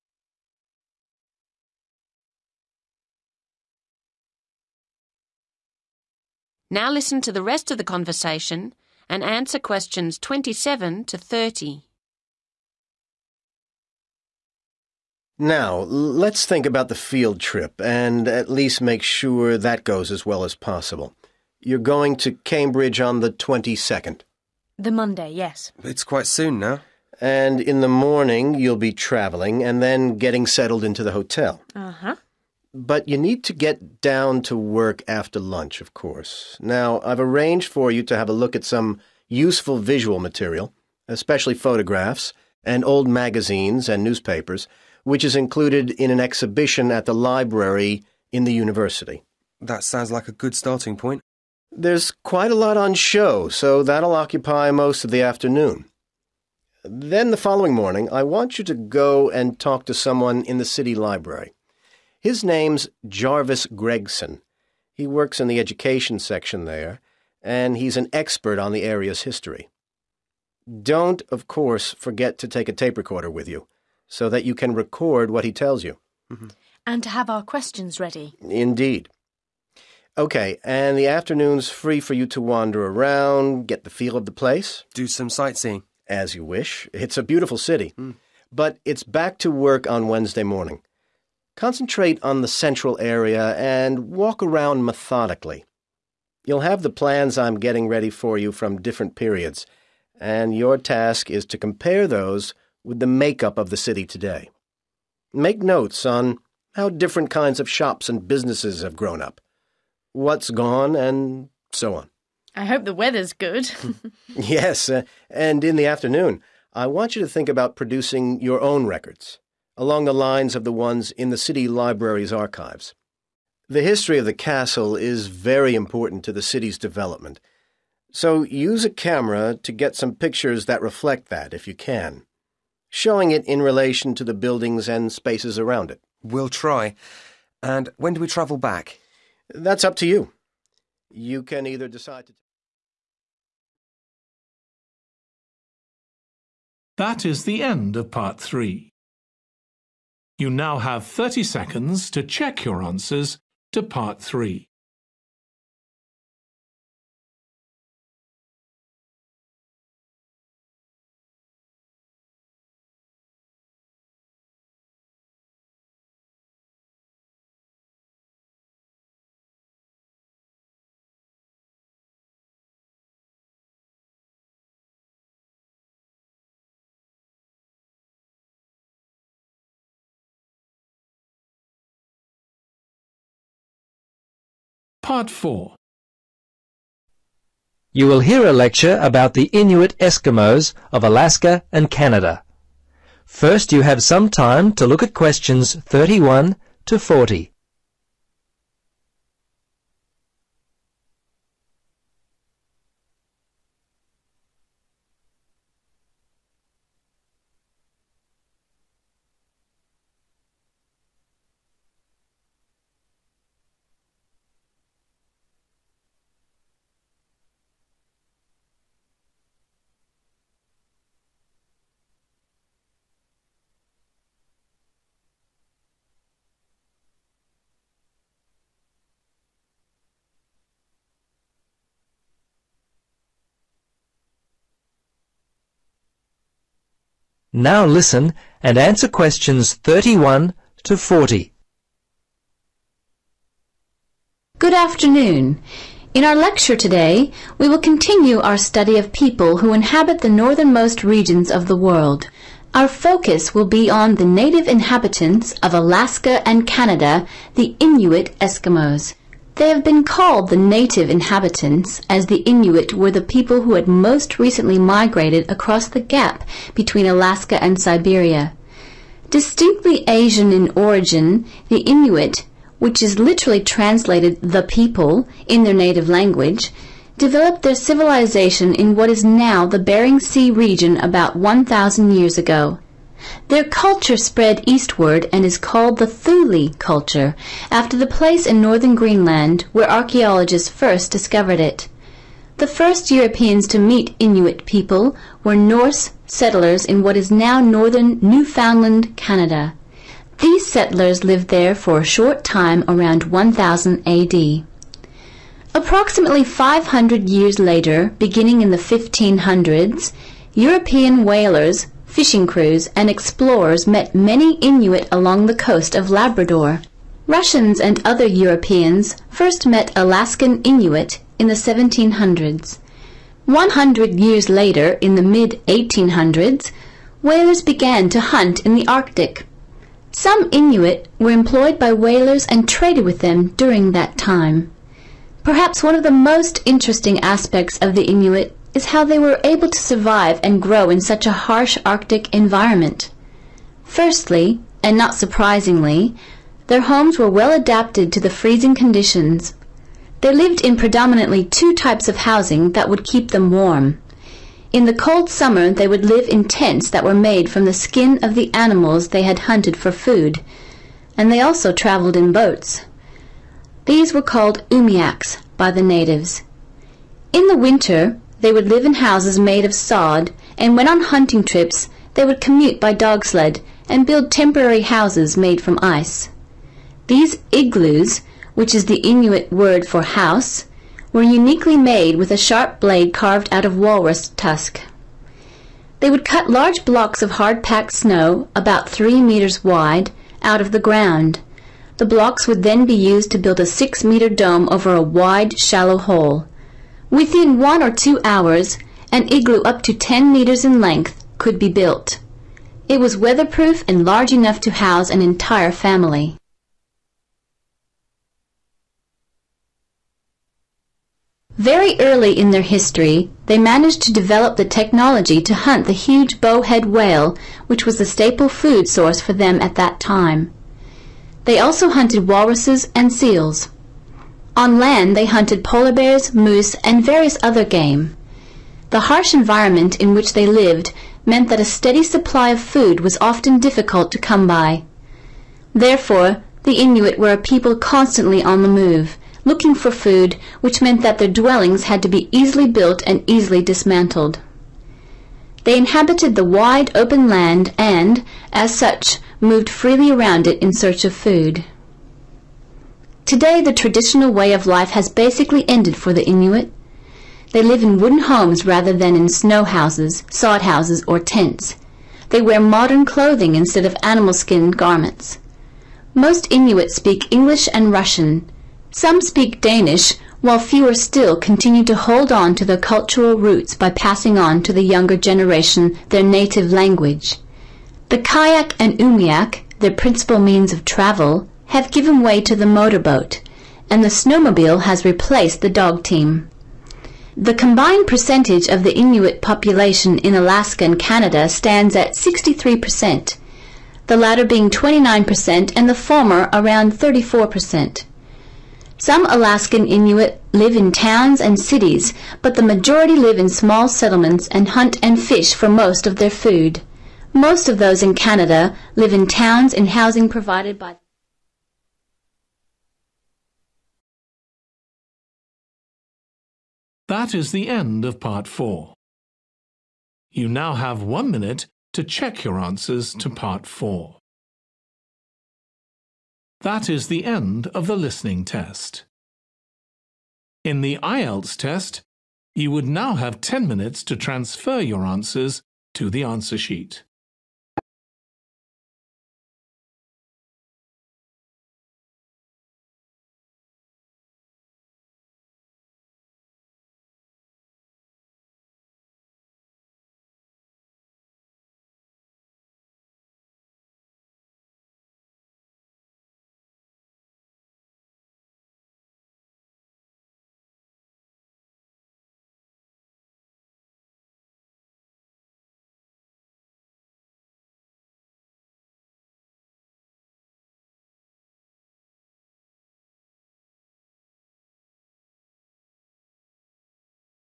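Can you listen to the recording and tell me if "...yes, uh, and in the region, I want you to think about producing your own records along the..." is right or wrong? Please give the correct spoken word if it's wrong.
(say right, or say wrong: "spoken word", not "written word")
wrong: "afternoon", not "region".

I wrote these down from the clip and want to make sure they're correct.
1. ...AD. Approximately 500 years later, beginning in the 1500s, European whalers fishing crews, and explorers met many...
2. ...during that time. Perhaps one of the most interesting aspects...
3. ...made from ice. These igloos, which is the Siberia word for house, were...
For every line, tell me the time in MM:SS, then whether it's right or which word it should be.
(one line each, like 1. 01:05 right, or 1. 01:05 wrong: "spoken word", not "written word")
1. 05:04 right
2. 05:33 right
3. 06:15 wrong: "Inuit", not "Siberia".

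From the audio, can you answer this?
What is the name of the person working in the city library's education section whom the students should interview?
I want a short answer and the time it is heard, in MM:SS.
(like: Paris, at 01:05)
Jarvis Gregson, at 01:03.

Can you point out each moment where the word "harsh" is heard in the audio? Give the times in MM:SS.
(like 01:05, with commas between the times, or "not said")
05:41, 07:09.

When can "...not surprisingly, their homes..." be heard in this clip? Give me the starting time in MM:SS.
05:44.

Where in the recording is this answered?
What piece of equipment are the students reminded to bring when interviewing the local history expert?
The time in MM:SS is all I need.
01:12.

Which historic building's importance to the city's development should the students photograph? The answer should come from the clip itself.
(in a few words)
the castle.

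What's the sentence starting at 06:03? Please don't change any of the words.
These were called umiaks by the natives.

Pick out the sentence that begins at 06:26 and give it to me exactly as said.
They would cut large blocks of hard-packed snow, about three meters wide, out of the ground.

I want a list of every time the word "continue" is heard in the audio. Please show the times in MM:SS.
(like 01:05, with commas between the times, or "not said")
04:07, 07:51.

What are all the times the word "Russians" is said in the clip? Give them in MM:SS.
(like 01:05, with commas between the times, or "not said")
05:17, 07:47.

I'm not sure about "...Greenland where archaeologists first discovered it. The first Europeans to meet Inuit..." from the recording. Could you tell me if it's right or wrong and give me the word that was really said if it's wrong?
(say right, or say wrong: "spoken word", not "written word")
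right.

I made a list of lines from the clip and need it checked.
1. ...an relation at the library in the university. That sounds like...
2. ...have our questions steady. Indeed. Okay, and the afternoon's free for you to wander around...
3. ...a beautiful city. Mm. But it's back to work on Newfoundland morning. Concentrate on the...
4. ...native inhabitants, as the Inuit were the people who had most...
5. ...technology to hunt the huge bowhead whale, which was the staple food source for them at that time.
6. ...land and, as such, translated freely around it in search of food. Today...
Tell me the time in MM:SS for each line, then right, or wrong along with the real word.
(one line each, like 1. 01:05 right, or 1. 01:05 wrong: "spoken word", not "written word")
1. 00:46 wrong: "exhibition", not "relation"
2. 01:17 wrong: "ready", not "steady"
3. 01:27 wrong: "Wednesday", not "Newfoundland"
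4. 04:20 right
5. 06:54 right
6. 07:27 wrong: "moved", not "translated".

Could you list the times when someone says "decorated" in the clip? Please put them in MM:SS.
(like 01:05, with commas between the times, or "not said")
not said.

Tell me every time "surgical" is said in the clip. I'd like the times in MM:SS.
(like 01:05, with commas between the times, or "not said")
not said.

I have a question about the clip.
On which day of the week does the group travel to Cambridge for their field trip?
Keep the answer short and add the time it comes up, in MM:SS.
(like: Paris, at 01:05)
Monday, at 00:24.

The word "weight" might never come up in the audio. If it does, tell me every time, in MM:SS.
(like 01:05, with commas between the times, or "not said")
not said.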